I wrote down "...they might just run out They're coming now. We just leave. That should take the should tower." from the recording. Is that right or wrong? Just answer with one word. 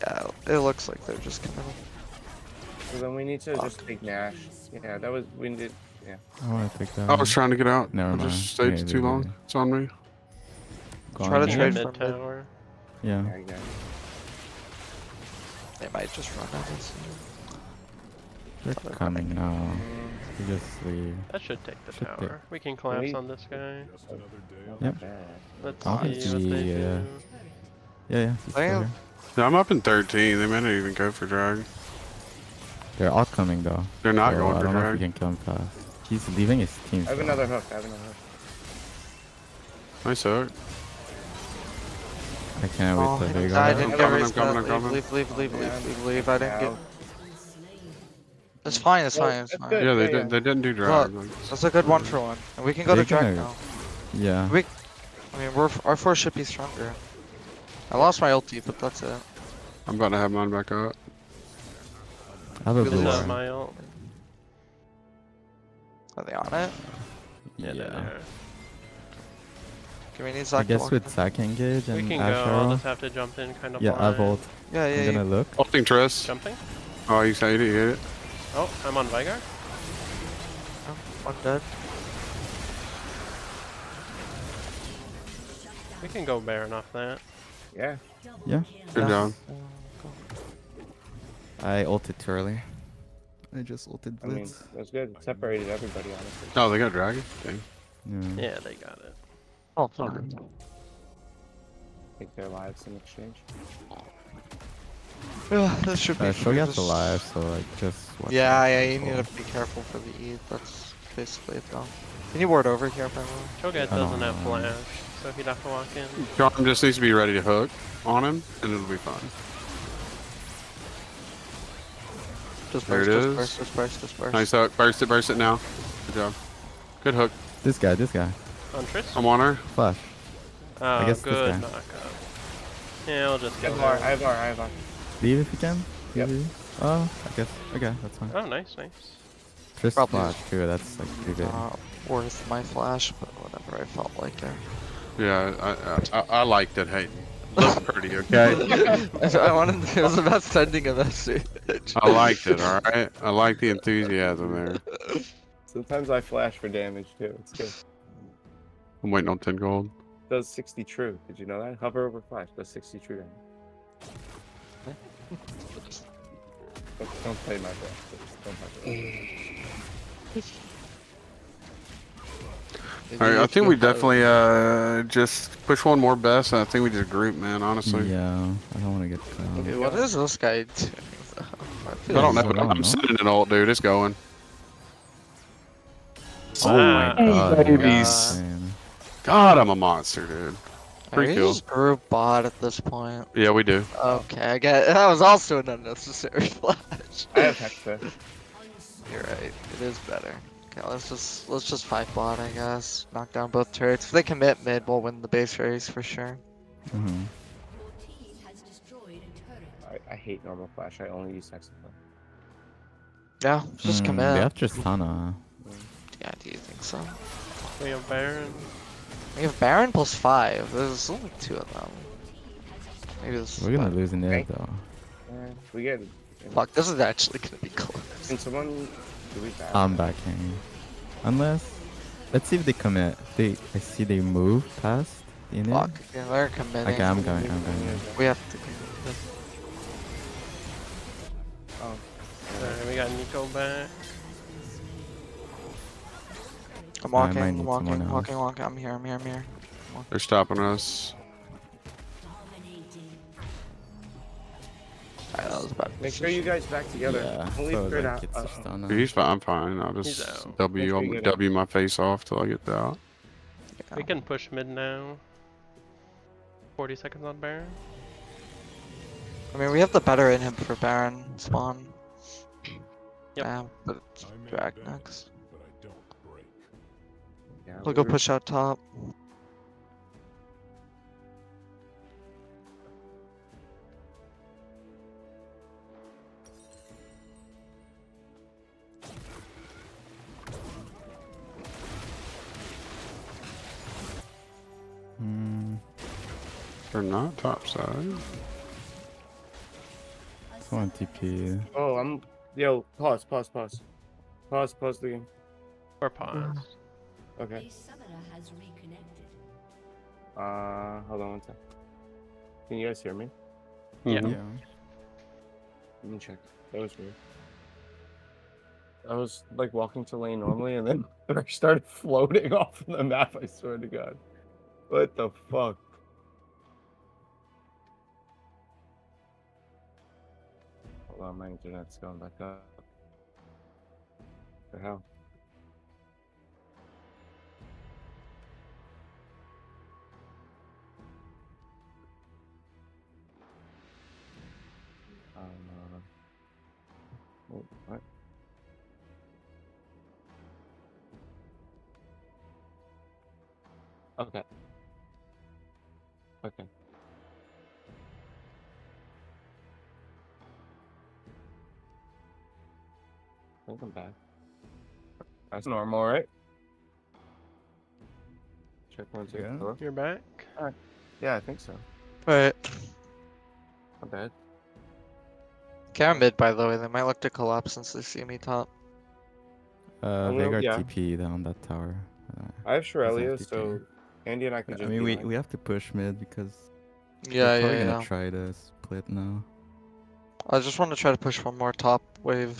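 right.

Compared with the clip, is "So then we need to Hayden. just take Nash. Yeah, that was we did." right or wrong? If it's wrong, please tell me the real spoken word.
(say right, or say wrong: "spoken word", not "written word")
wrong: "Fuck", not "Hayden".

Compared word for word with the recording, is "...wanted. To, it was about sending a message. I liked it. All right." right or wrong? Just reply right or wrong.
right.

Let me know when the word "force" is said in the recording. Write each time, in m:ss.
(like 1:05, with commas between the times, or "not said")
0:55.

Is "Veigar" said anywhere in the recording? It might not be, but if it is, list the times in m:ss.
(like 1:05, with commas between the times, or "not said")
1:19, 6:20.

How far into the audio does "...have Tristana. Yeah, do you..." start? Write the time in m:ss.
3:34.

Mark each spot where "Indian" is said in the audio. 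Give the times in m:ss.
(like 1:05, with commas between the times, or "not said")
not said.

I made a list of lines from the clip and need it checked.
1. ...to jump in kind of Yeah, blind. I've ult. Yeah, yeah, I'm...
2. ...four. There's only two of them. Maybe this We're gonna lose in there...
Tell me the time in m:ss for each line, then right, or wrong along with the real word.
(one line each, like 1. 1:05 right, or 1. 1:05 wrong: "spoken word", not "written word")
1. 1:13 right
2. 3:40 wrong: "five", not "four".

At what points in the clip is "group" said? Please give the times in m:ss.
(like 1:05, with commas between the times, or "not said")
2:57, 3:11.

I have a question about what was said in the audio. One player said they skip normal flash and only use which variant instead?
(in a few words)
Hextech.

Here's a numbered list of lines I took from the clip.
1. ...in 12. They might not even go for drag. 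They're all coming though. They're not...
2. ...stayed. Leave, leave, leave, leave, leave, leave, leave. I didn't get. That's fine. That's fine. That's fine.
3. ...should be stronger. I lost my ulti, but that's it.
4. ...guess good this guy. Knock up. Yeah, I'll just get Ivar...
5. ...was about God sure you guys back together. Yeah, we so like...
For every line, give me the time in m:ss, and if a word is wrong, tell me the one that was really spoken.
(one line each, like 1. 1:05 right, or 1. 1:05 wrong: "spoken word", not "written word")
1. 0:29 wrong: "13", not "12"
2. 0:44 wrong: "raised", not "stayed"
3. 0:56 right
4. 2:11 right
5. 4:15 wrong: "Make", not "God".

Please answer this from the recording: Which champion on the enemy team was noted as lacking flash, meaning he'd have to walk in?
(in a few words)
Cho'Gath.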